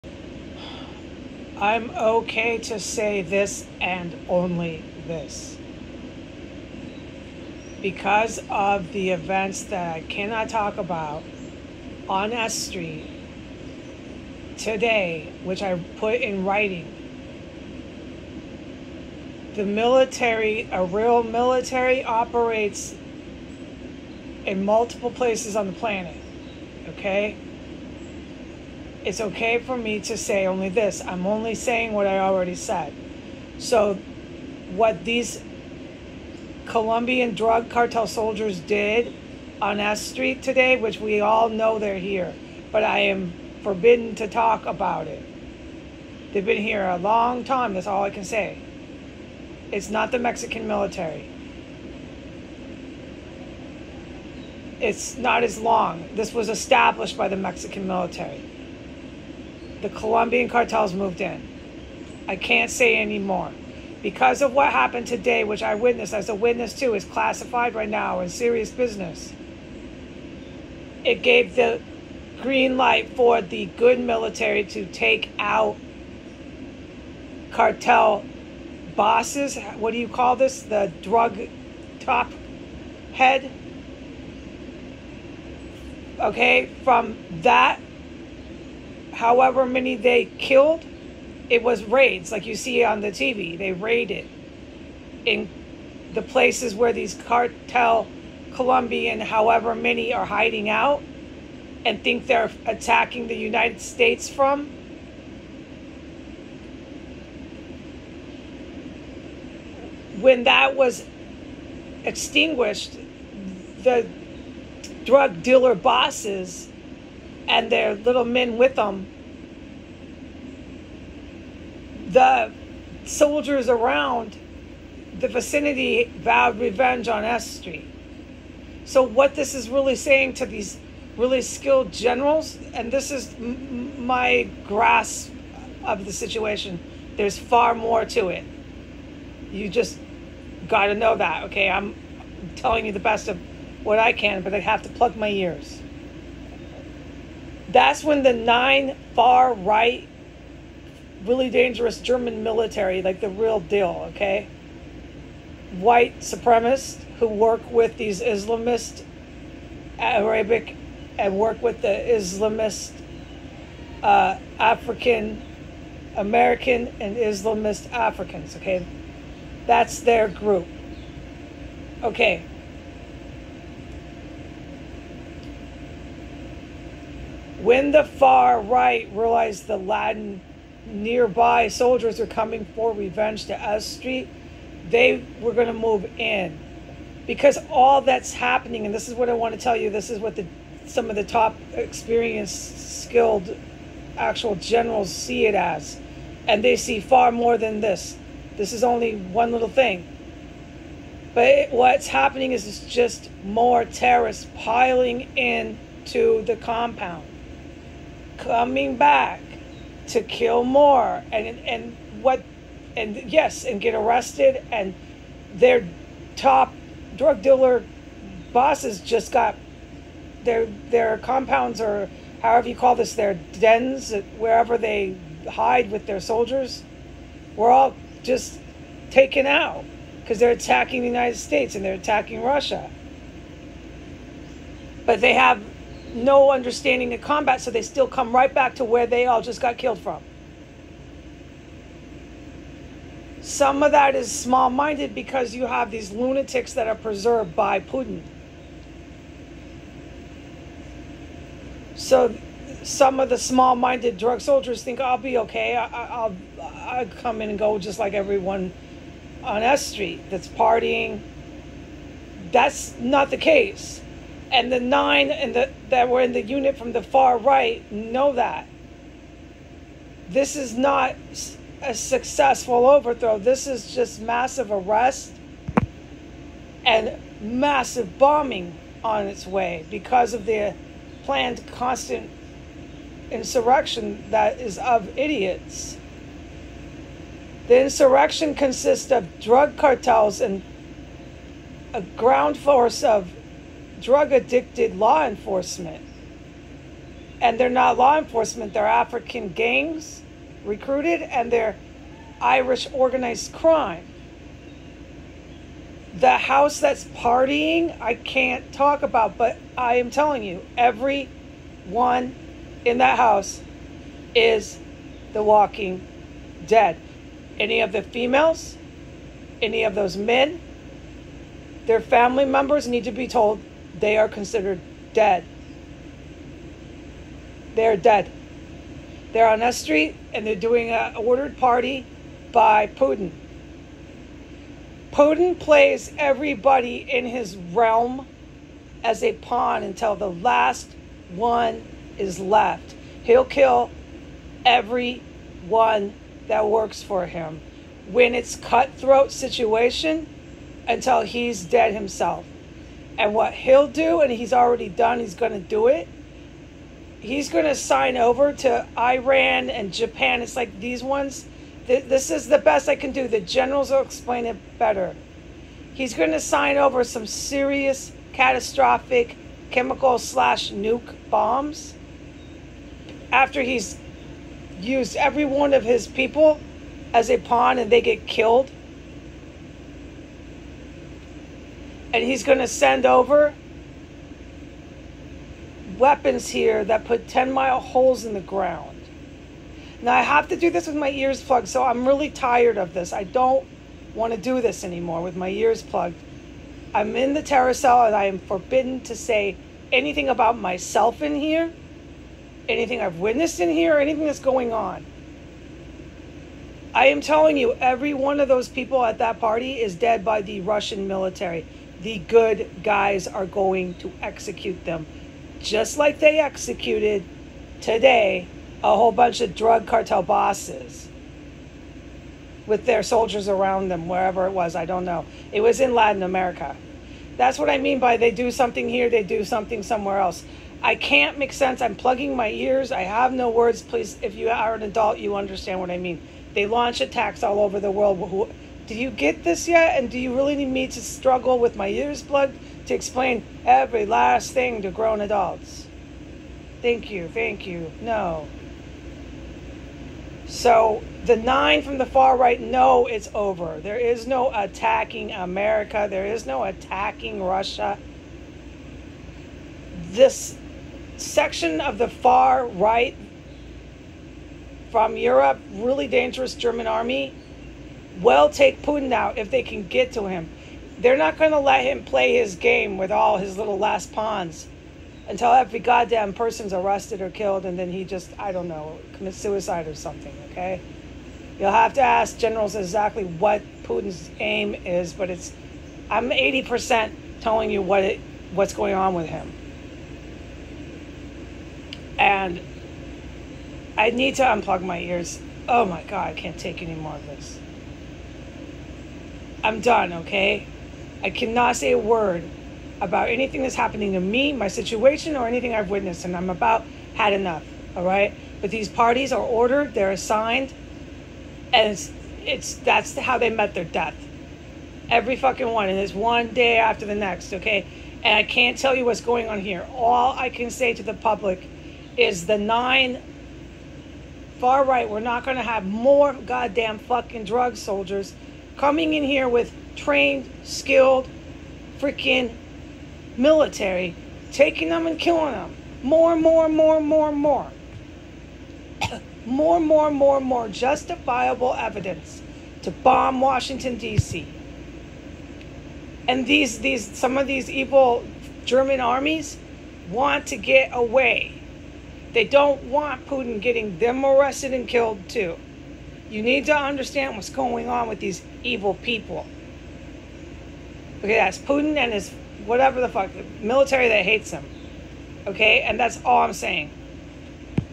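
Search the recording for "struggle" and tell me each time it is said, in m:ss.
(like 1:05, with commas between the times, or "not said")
7:21.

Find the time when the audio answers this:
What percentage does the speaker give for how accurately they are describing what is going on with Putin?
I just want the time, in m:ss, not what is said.
8:06.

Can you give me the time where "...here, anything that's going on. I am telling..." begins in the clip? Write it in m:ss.
6:43.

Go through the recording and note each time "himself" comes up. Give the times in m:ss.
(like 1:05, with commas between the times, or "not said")
5:51.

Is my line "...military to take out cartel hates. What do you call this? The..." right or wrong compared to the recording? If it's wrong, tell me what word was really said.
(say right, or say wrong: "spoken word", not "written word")
wrong: "bosses", not "hates".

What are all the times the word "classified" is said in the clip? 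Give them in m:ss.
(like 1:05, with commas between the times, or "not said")
1:07.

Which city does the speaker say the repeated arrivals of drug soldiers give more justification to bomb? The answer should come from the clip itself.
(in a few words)
Washington, D.C.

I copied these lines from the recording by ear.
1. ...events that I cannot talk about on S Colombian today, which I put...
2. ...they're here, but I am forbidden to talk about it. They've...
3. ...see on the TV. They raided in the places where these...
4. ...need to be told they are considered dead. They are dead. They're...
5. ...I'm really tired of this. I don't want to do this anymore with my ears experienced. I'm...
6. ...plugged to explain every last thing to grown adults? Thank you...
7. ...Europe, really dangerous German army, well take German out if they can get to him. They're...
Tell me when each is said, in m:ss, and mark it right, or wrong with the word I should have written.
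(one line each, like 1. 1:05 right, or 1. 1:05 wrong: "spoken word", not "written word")
1. 0:09 wrong: "Street", not "Colombian"
2. 0:41 right
3. 1:32 right
4. 5:22 right
5. 6:31 wrong: "plugged", not "experienced"
6. 7:22 right
7. 7:45 wrong: "Putin", not "German".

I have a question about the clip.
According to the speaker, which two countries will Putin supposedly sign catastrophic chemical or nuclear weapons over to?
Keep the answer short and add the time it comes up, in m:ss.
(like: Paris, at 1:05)
Iran and Japan, at 5:58.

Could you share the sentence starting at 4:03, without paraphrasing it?
Some of that is small minded because you have these lunatics that are preserved by Putin.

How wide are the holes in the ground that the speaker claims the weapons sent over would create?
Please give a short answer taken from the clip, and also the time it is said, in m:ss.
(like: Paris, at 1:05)
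10 miles, at 6:27.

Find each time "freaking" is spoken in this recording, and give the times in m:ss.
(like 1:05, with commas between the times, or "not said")
8:51.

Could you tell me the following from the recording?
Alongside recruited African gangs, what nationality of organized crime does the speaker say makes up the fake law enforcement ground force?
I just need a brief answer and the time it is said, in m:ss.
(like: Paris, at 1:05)
Irish, at 5:02.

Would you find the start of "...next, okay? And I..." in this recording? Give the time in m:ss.
8:37.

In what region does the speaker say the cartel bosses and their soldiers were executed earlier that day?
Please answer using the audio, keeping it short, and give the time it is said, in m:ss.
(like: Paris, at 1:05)
Latin America, at 7:05.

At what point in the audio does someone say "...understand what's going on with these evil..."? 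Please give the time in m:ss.
9:16.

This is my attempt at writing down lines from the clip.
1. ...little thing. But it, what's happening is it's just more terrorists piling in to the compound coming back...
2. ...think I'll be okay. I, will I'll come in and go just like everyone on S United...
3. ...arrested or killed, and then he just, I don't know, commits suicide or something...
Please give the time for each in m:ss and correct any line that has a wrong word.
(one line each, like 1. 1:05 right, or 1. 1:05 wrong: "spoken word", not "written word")
1. 3:19 right
2. 4:14 wrong: "Street", not "United"
3. 7:56 right.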